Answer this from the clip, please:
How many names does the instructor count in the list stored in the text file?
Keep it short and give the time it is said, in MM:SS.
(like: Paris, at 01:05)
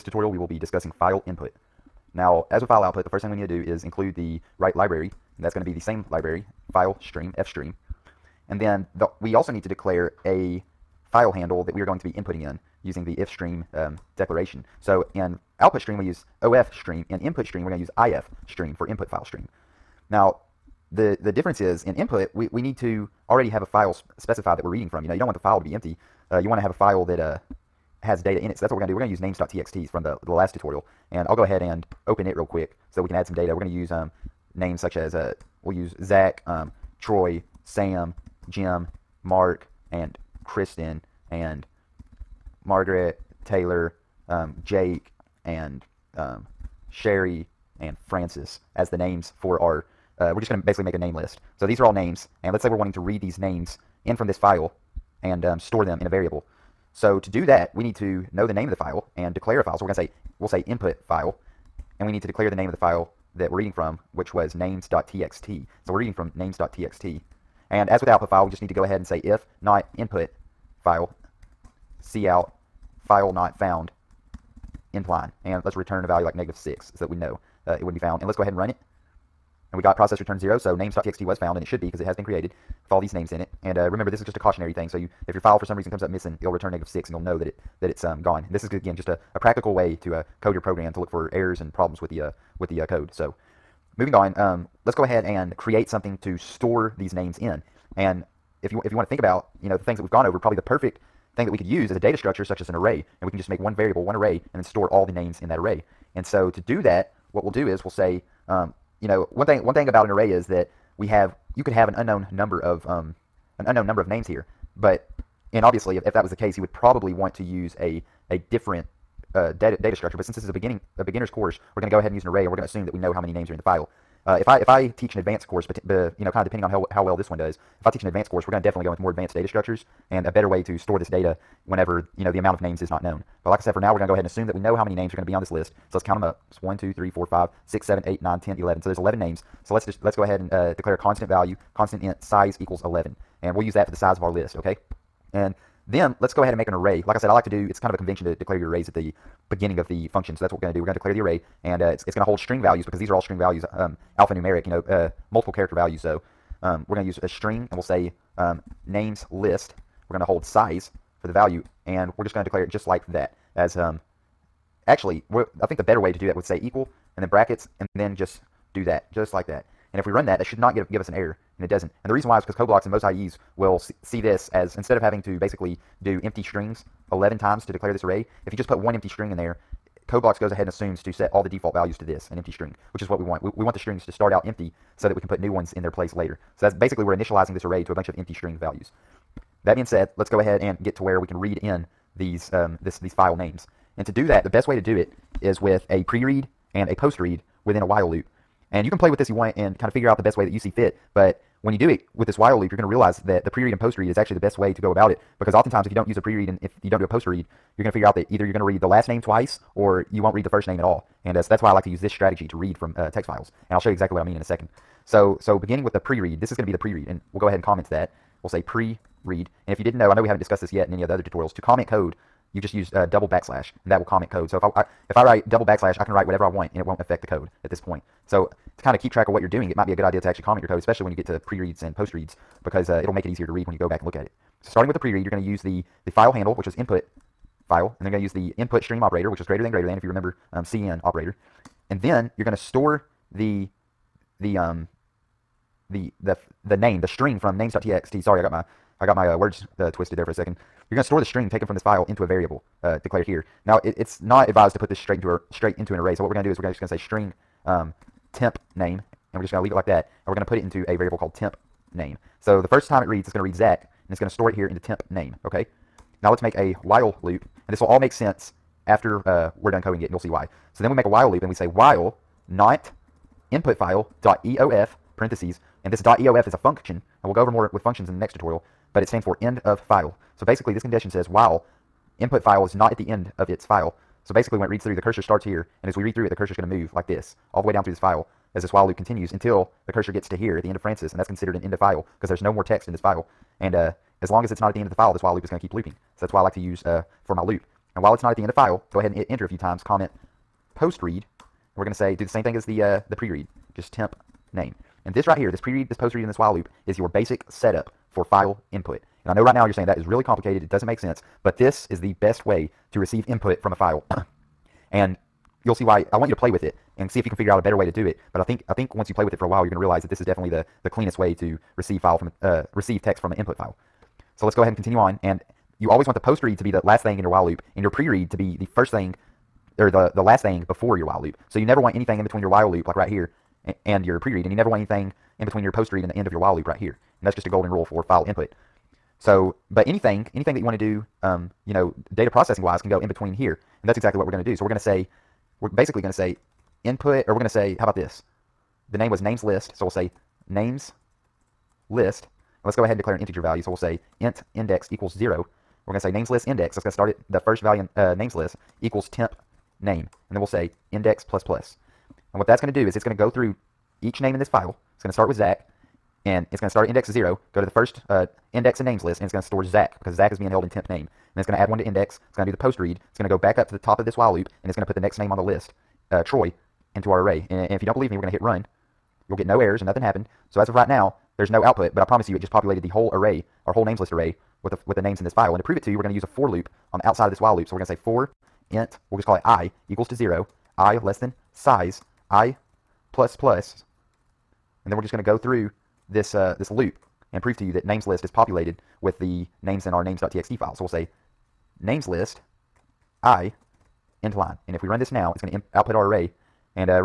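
11, at 02:18.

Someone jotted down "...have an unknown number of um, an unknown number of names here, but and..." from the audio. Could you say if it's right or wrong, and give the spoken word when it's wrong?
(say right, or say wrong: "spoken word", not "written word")
right.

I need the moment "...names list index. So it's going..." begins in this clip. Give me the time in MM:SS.
05:56.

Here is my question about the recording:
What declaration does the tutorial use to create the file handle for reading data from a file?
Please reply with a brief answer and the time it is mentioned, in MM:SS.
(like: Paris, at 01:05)
ifstream, at 00:17.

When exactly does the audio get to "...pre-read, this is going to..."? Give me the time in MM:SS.
03:35.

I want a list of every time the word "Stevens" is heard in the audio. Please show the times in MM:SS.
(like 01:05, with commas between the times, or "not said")
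not said.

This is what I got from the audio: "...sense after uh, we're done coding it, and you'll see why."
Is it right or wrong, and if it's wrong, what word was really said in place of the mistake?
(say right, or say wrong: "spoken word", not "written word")
right.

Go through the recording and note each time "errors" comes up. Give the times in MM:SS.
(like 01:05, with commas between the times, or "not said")
01:31, 02:51, 06:19.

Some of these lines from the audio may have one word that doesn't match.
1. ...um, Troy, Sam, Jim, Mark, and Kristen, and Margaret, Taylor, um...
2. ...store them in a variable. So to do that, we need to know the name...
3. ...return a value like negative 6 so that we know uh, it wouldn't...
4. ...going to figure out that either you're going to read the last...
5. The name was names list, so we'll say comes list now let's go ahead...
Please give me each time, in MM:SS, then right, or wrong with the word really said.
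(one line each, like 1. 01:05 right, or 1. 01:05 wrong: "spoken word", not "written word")
1. 00:36 right
2. 00:55 right
3. 01:15 right
4. 03:27 right
5. 05:48 wrong: "names", not "comes".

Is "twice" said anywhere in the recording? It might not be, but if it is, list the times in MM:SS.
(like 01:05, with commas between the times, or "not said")
03:29.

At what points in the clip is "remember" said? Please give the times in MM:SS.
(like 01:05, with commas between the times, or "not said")
01:23, 04:00.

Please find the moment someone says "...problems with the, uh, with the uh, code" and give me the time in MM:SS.
01:31.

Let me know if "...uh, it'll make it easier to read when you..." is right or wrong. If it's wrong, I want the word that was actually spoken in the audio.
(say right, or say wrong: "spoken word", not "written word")
right.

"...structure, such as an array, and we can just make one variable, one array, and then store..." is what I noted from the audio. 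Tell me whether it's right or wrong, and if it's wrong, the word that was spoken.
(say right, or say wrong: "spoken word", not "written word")
right.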